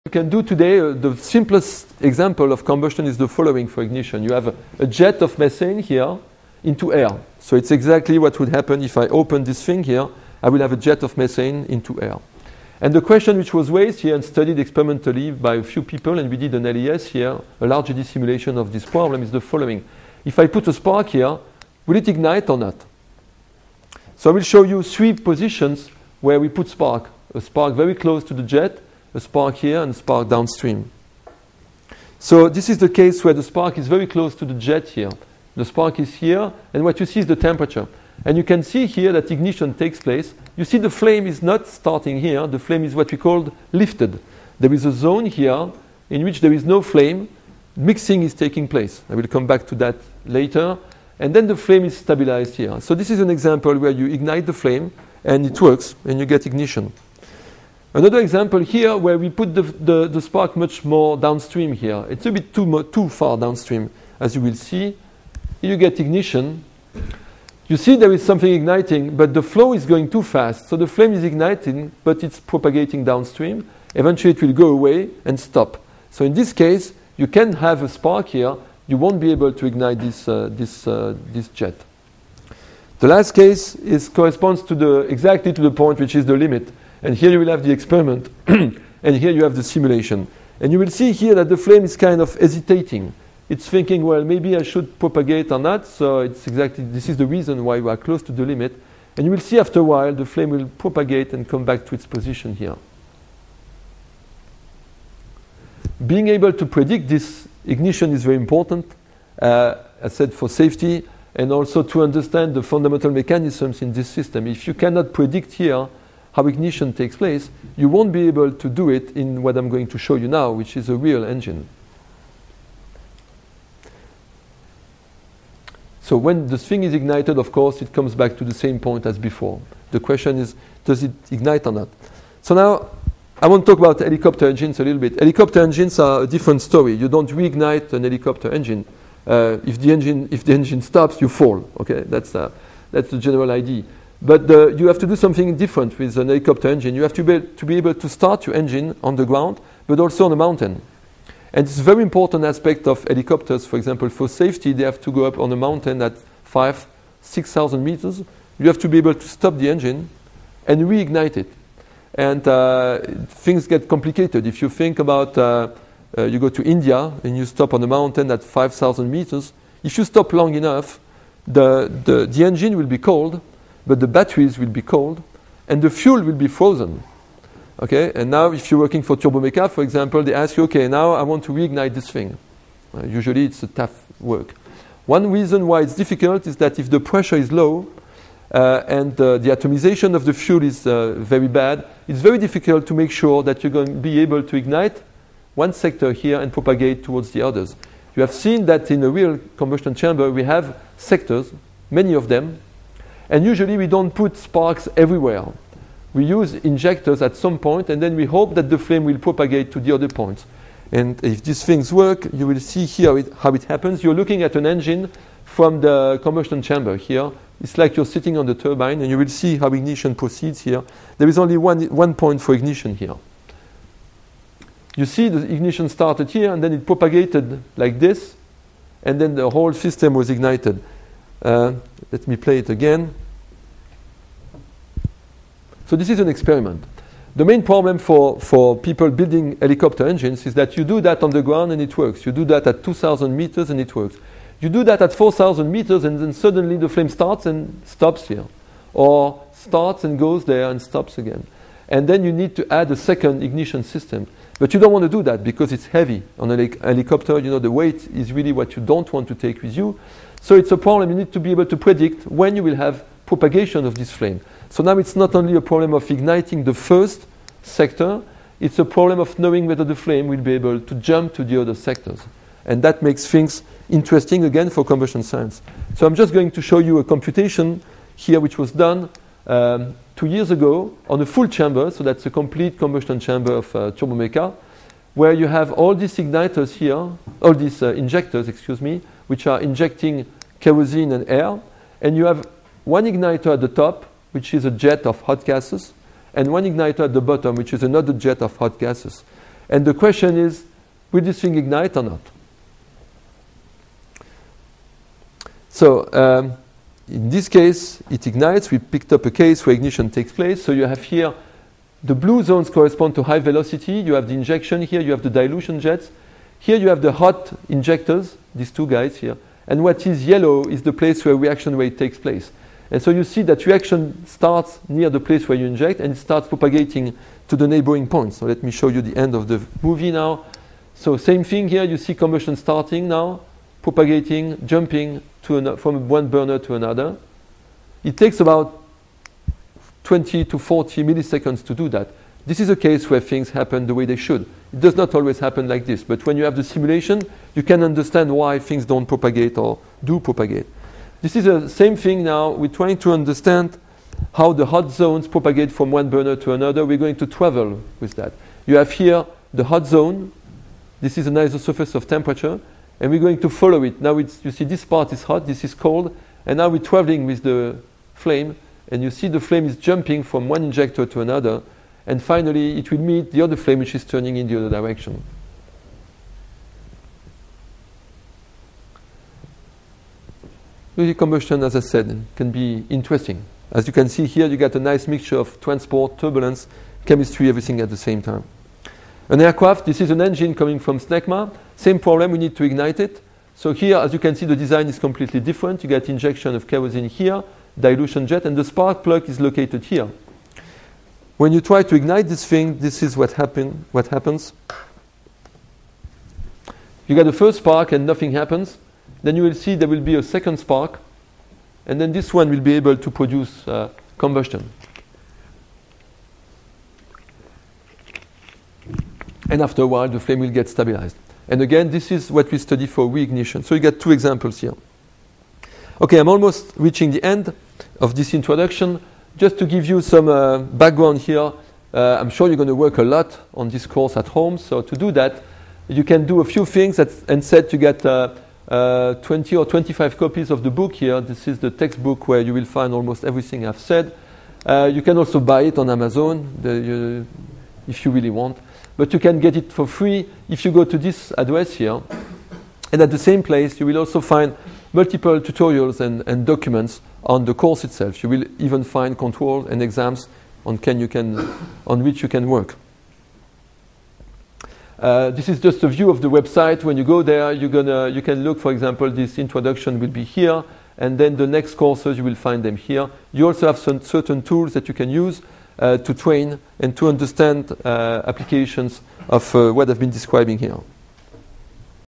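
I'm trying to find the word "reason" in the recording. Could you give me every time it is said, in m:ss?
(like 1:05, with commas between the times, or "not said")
1:37, 3:05.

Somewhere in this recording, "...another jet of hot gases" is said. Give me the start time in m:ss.
4:57.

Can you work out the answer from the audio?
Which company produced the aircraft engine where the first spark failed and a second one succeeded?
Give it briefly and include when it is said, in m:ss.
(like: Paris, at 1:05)
SNECMA, at 6:30.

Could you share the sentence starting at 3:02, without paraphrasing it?
Uh, usually it's a tough work.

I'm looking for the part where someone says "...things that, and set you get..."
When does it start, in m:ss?
7:16.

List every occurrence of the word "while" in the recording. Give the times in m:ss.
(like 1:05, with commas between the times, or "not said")
1:39, 6:59.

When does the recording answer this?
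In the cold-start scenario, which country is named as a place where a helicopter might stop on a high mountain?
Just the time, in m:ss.
2:46.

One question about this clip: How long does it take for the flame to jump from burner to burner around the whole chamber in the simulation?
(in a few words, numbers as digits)
20 to 40 milliseconds.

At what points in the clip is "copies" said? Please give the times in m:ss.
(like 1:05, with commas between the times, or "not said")
7:20.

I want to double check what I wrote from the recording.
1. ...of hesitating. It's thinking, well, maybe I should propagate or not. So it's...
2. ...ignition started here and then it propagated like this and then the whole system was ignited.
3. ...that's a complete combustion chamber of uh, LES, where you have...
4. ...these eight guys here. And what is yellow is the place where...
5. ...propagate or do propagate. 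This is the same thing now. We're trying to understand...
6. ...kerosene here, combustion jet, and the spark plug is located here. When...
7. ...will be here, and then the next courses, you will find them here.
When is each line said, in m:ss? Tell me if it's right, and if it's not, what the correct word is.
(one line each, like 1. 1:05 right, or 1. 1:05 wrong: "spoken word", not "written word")
1. 1:32 right
2. 3:45 right
3. 4:42 wrong: "Turbomeca", not "LES"
4. 5:18 wrong: "two", not "eight"
5. 5:49 right
6. 6:36 wrong: "dilution", not "combustion"
7. 7:49 right.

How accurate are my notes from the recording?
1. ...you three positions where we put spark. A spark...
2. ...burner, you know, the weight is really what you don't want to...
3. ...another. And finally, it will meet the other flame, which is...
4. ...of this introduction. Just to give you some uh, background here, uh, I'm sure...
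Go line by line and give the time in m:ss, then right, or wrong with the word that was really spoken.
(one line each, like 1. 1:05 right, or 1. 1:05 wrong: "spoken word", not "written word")
1. 0:24 right
2. 4:16 wrong: "helicopter", not "burner"
3. 6:11 right
4. 7:07 right.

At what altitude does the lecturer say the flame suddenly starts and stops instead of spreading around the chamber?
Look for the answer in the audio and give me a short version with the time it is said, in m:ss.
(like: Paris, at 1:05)
4,000 meters, at 4:05.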